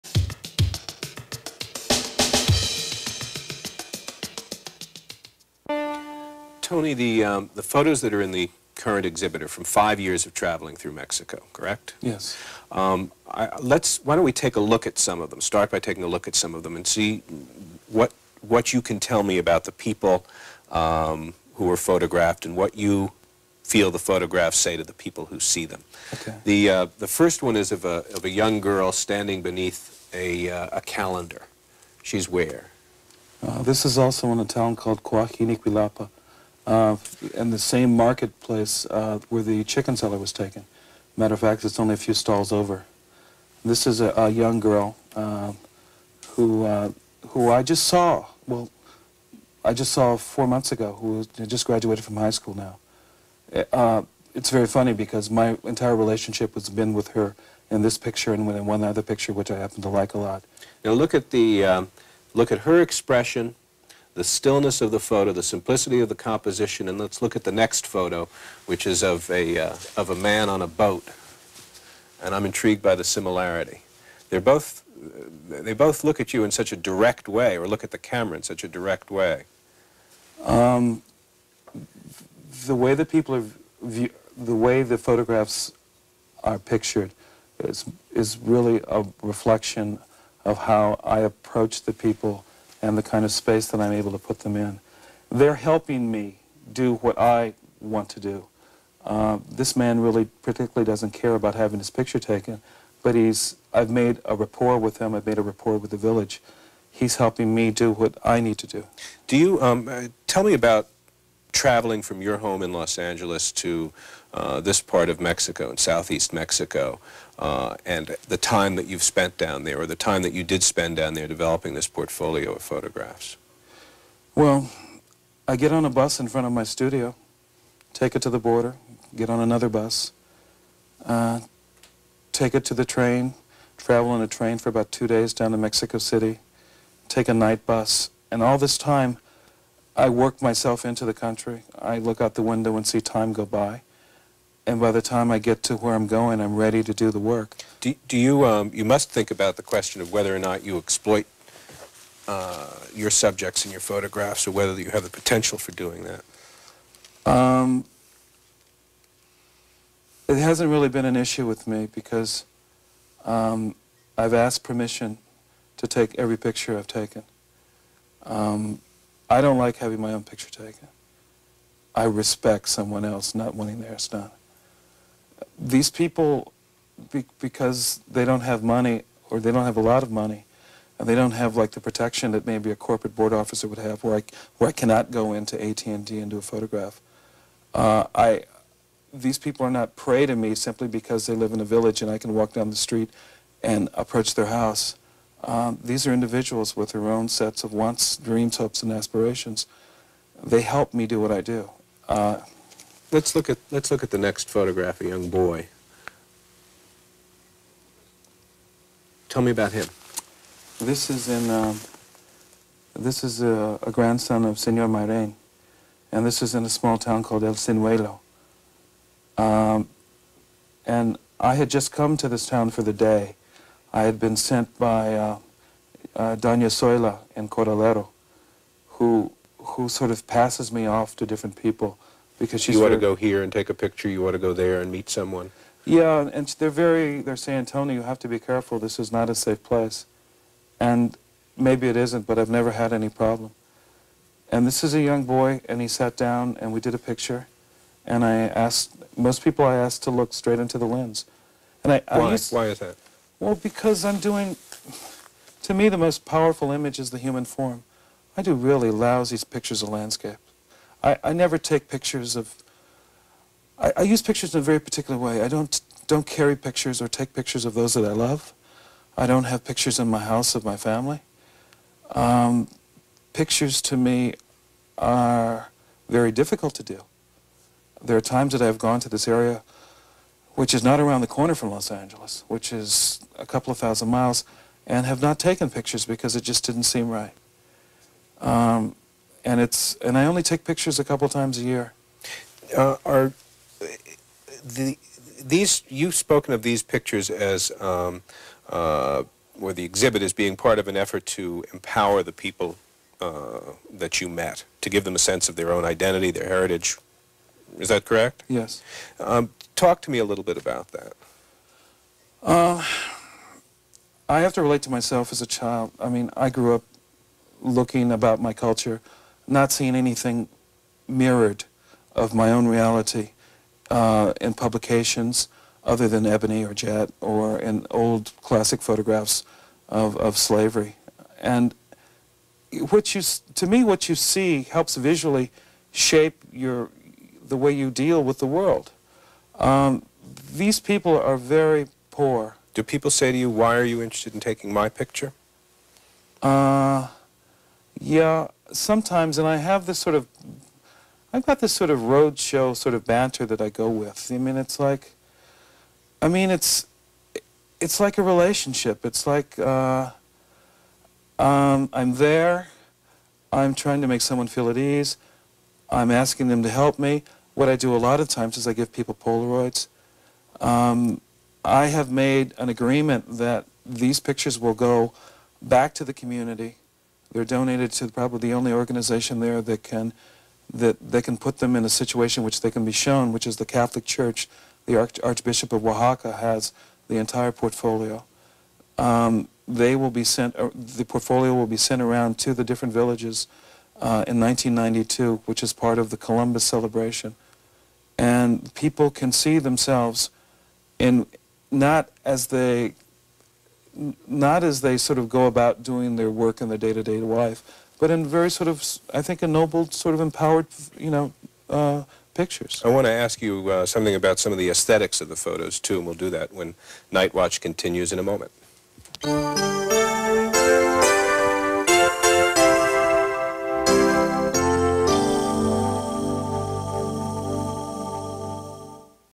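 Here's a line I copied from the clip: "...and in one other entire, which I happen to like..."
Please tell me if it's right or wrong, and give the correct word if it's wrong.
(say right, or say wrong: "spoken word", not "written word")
wrong: "picture", not "entire".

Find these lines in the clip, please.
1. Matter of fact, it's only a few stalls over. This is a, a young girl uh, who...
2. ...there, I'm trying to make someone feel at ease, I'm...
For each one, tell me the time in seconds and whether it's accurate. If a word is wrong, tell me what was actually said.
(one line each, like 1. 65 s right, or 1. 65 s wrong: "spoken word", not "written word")
1. 41 s right
2. 362 s right.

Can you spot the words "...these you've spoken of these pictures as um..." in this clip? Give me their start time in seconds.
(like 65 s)
295 s.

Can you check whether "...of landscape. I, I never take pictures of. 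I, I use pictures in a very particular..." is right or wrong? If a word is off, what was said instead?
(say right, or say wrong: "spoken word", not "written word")
right.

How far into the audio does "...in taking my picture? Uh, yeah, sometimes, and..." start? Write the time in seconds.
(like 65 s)
344 s.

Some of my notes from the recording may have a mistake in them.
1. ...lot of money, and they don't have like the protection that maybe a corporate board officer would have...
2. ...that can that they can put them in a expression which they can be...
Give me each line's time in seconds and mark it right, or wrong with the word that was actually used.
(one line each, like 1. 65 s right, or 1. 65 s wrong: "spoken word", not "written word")
1. 179 s right
2. 379 s wrong: "situation", not "expression".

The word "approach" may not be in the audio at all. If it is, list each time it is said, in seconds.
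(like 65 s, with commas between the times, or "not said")
91 s, 193 s.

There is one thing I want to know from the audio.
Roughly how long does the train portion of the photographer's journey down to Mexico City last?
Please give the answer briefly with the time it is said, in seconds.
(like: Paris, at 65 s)
About two days, at 134 s.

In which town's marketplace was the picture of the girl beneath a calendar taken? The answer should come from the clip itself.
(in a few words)
Coahuilapa.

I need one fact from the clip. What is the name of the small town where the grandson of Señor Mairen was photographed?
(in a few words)
El Ciruelo.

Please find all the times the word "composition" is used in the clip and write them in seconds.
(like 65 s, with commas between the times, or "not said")
66 s.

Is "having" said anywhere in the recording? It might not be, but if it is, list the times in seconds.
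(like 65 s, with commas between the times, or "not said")
101 s, 169 s.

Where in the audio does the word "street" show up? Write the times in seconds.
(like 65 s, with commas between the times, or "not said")
192 s.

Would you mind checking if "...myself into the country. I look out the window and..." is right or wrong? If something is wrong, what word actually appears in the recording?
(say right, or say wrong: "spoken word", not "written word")
right.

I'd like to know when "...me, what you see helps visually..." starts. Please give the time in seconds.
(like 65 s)
333 s.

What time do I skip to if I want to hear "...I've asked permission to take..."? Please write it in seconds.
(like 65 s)
164 s.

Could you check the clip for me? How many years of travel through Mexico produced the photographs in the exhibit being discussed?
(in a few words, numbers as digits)
5.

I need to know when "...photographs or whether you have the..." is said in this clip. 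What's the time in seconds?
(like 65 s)
153 s.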